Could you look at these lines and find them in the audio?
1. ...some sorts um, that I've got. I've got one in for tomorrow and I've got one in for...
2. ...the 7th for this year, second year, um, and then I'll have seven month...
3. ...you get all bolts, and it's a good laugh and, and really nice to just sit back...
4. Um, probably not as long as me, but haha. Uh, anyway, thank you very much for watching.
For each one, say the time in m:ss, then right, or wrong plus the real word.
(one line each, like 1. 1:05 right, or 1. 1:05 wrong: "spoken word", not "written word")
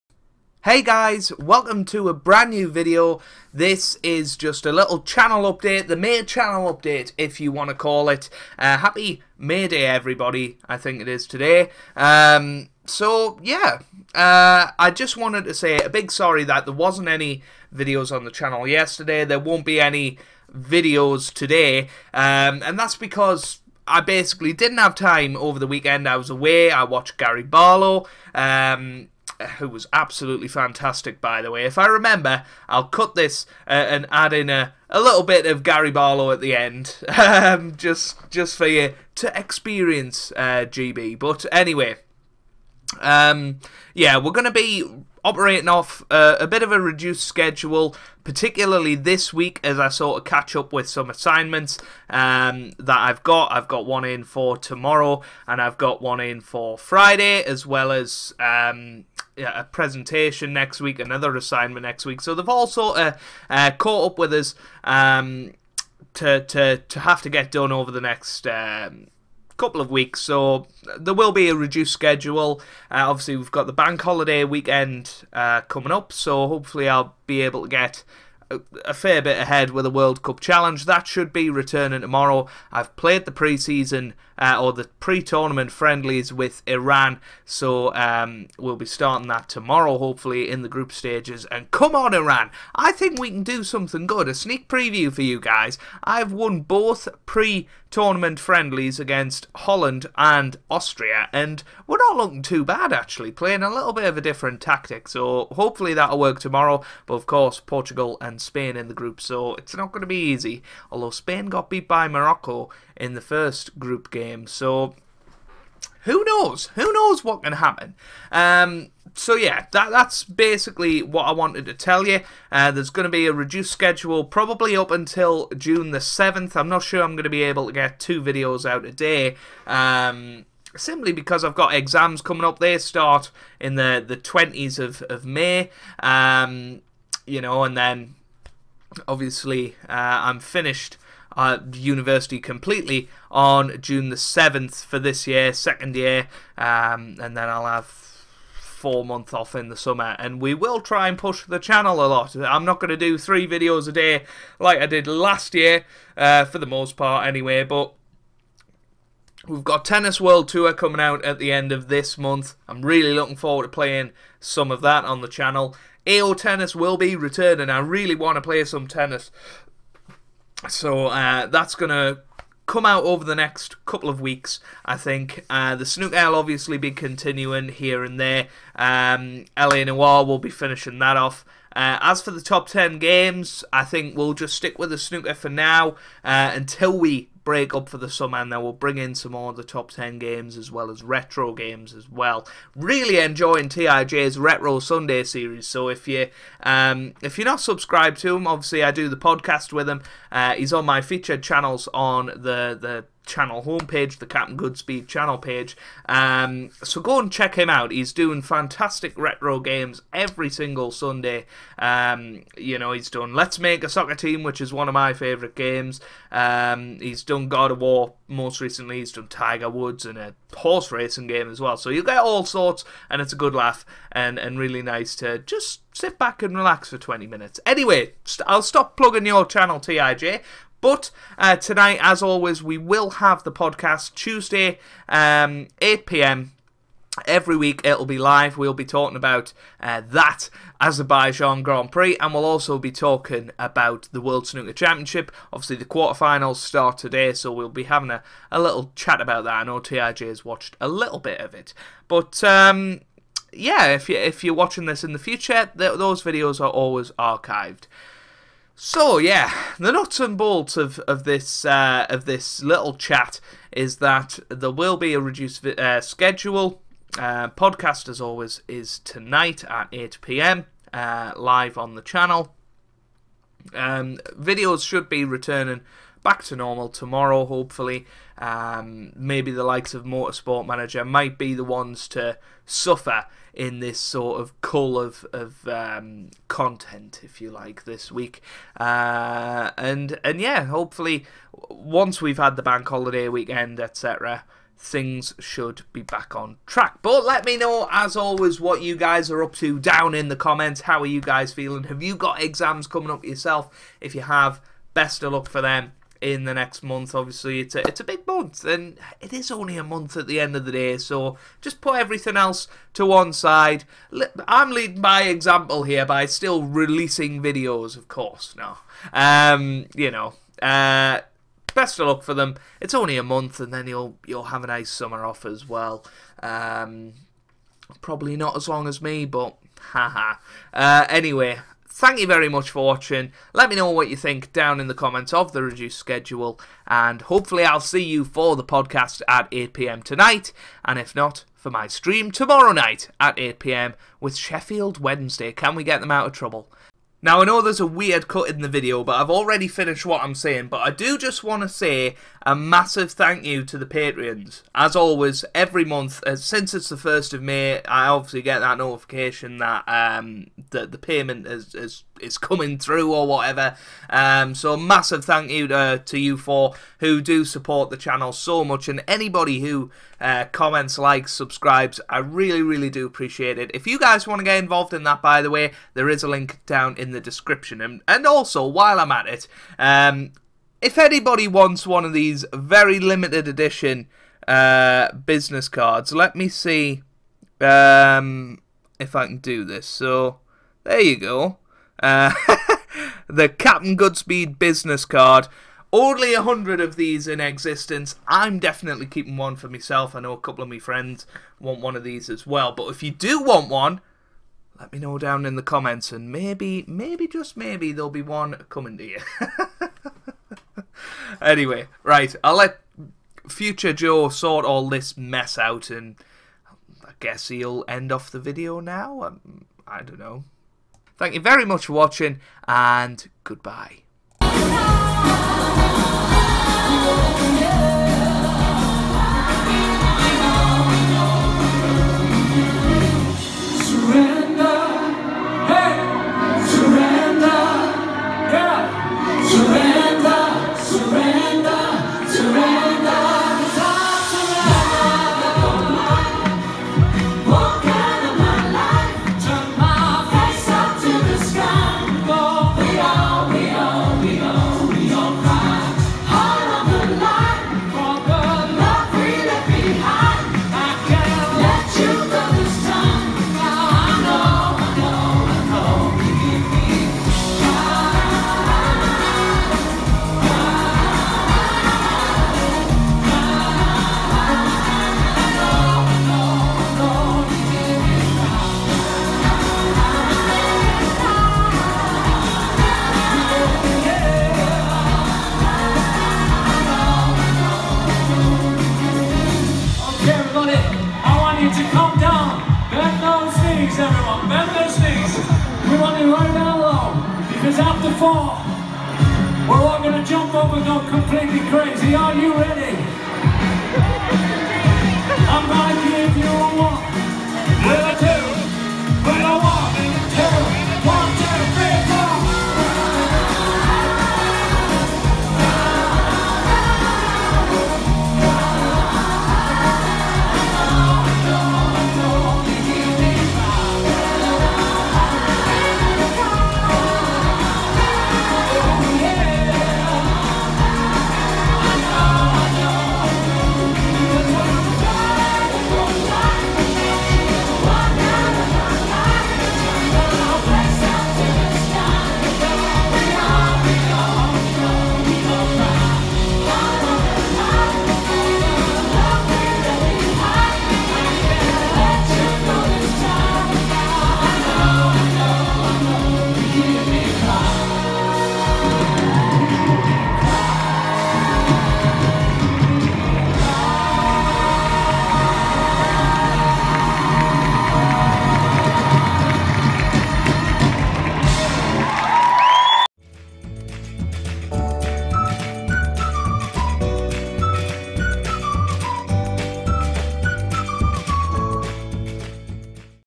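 1. 0:50 wrong: "assignments", not "sorts"
2. 2:24 wrong: "four", not "seven"
3. 3:41 wrong: "sorts", not "bolts"
4. 5:26 right.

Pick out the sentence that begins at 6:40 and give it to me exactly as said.
I know a couple of my friends want one of these as well.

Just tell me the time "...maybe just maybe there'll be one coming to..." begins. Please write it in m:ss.
6:46.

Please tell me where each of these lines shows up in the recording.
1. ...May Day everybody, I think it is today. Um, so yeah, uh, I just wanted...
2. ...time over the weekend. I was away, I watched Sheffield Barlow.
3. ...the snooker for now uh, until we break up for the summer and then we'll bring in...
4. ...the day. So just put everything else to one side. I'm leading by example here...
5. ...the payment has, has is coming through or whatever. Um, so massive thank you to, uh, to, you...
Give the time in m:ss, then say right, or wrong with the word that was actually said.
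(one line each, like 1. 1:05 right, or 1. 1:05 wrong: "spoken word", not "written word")
1. 0:09 right
2. 0:24 wrong: "Gary", not "Sheffield"
3. 3:04 right
4. 5:10 right
5. 6:00 right.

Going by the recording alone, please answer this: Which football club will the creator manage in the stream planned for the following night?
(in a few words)
Sheffield Wednesday.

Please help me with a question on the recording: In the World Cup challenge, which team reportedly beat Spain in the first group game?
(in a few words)
Morocco.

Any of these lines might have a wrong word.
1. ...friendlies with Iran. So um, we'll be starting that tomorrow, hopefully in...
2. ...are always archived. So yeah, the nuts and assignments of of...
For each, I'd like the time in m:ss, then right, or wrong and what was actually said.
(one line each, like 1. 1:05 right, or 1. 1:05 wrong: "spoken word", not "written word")
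1. 1:25 right
2. 4:16 wrong: "bolts", not "assignments".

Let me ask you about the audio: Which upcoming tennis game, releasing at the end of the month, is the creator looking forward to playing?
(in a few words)
Tennis World Tour.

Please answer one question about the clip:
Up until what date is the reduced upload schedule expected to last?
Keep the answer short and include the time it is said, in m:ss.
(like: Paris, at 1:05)
June 7, at 2:05.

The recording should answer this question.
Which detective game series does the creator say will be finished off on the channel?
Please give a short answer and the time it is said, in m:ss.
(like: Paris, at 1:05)
LA Noire, at 2:59.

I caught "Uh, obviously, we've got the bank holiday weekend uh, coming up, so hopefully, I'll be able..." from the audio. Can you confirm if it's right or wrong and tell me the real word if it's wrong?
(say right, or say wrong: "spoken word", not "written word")
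right.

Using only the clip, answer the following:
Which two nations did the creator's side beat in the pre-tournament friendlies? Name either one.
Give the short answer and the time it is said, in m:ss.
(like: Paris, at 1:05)
Holland and Austria, at 1:39.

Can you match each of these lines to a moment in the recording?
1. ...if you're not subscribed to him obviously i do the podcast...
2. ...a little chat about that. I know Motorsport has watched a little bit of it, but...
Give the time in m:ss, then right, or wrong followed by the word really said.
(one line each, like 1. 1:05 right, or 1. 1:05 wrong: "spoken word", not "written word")
1. 3:17 right
2. 4:08 wrong: "TIJ", not "Motorsport".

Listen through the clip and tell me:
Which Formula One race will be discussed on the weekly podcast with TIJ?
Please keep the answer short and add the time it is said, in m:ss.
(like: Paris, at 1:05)
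Azerbaijan Grand Prix, at 4:00.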